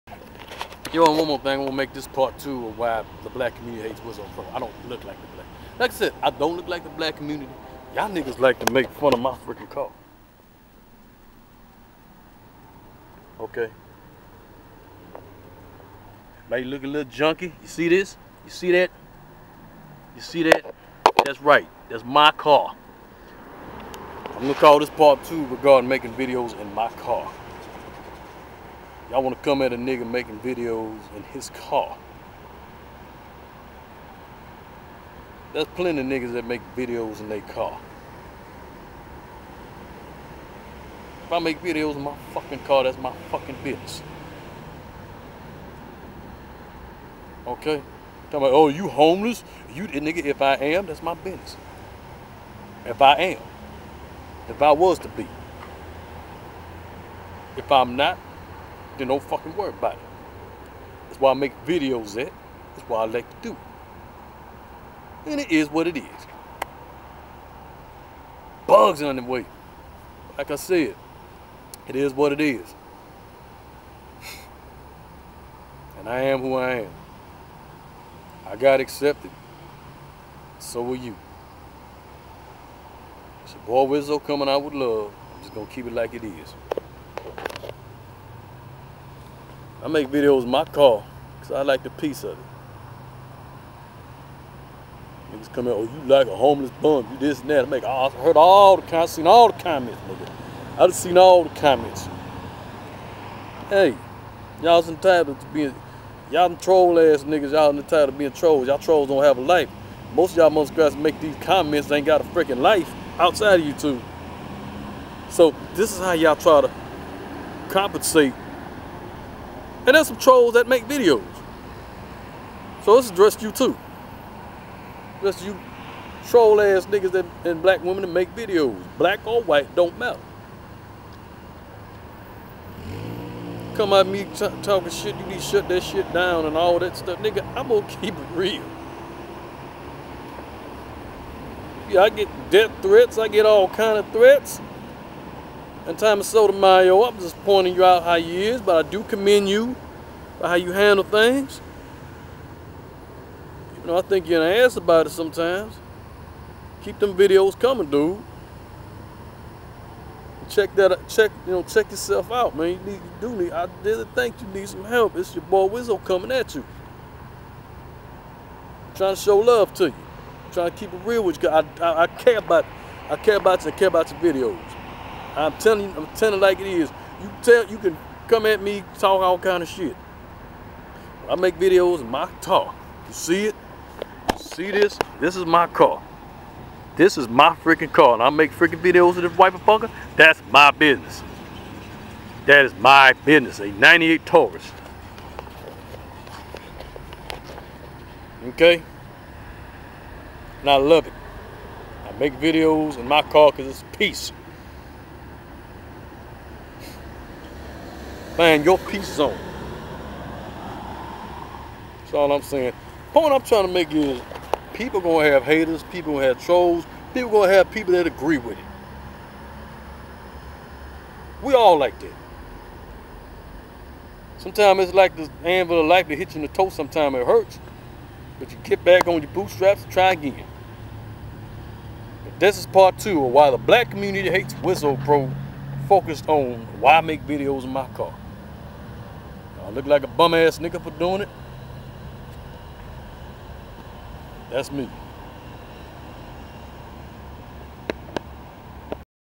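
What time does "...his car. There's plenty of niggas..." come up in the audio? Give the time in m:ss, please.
0:31.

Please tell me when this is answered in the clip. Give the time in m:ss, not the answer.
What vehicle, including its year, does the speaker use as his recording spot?
3:13.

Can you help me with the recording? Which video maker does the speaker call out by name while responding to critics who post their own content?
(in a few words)
Thomas Sotomayor.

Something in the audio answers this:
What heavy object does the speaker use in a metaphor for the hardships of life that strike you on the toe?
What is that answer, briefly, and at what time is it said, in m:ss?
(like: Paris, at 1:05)
anvil, at 3:45.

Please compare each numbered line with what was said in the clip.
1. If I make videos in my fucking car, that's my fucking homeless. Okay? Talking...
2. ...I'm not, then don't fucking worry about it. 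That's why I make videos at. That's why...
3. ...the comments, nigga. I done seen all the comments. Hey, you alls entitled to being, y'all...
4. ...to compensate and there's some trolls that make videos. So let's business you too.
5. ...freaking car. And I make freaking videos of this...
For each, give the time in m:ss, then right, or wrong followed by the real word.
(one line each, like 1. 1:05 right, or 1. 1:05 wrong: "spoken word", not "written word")
1. 0:41 wrong: "business", not "homeless"
2. 0:57 right
3. 1:39 right
4. 1:56 wrong: "address", not "business"
5. 3:07 right.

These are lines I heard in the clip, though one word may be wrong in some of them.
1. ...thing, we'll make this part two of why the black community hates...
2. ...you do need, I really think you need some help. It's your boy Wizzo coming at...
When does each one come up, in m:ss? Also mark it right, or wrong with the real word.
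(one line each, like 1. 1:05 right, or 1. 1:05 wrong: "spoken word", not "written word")
1. 0:01 right
2. 2:42 right.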